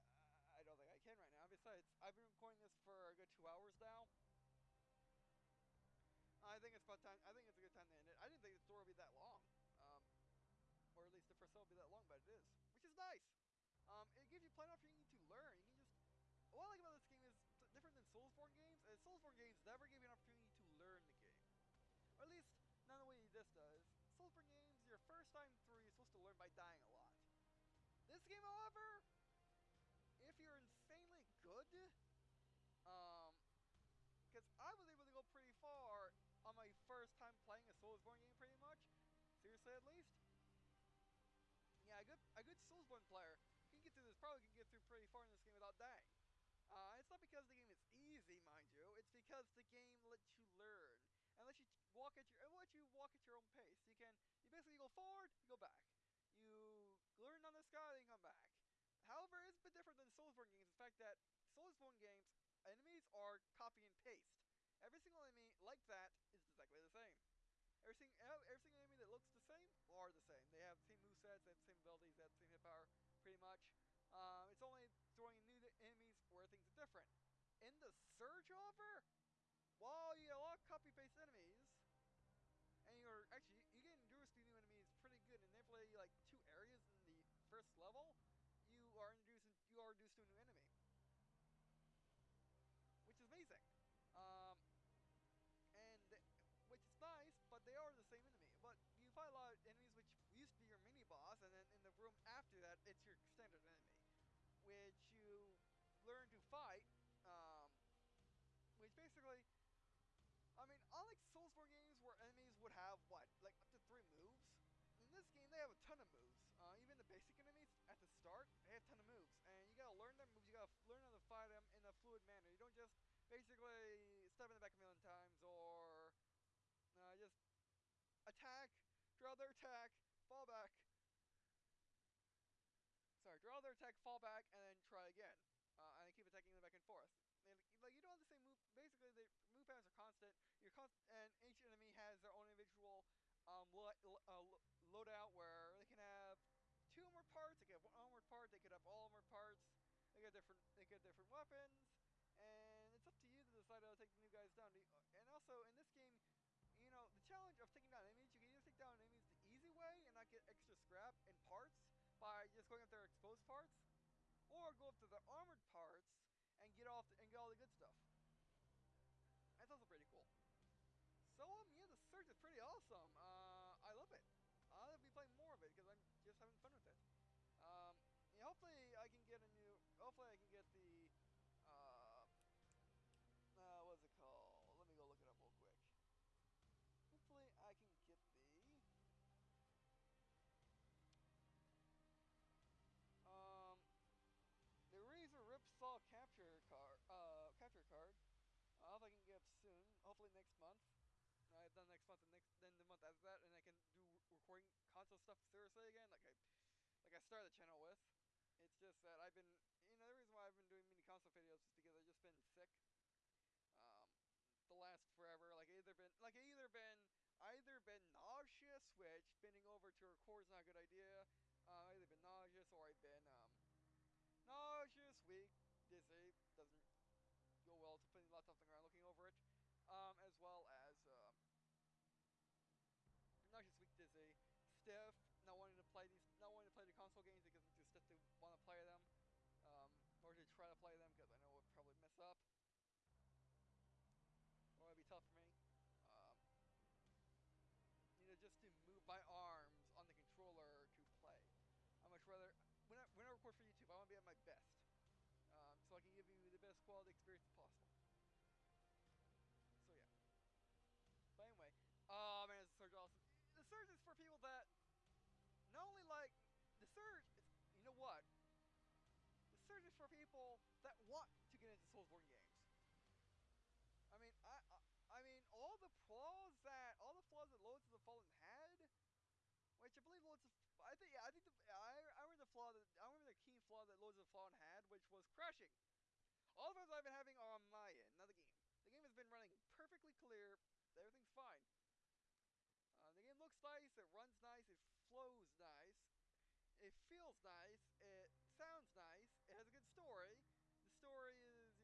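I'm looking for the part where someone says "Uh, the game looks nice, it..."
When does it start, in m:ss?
4:53.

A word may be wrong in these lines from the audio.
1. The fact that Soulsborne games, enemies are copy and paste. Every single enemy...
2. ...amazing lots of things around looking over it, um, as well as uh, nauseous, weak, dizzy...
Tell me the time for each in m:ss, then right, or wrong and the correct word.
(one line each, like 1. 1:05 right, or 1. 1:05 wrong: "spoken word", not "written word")
1. 1:00 right
2. 3:48 wrong: "putting", not "amazing".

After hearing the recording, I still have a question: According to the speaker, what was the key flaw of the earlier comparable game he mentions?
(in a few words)
Crashing.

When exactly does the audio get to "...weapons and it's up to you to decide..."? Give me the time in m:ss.
2:31.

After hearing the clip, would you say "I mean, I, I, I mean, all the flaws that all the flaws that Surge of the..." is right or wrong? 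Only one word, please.
wrong.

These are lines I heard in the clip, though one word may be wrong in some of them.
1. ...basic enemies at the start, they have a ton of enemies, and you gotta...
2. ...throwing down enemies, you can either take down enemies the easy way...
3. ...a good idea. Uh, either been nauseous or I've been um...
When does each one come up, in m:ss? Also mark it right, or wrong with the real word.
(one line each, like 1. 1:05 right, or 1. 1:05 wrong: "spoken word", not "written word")
1. 1:57 wrong: "moves", not "enemies"
2. 2:37 wrong: "taking", not "throwing"
3. 3:40 right.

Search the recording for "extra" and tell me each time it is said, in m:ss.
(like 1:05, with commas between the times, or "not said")
2:40.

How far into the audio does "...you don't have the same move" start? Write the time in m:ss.
2:17.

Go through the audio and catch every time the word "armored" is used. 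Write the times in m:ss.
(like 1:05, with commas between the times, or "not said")
2:45.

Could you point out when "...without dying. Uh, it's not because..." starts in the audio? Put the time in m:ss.
0:45.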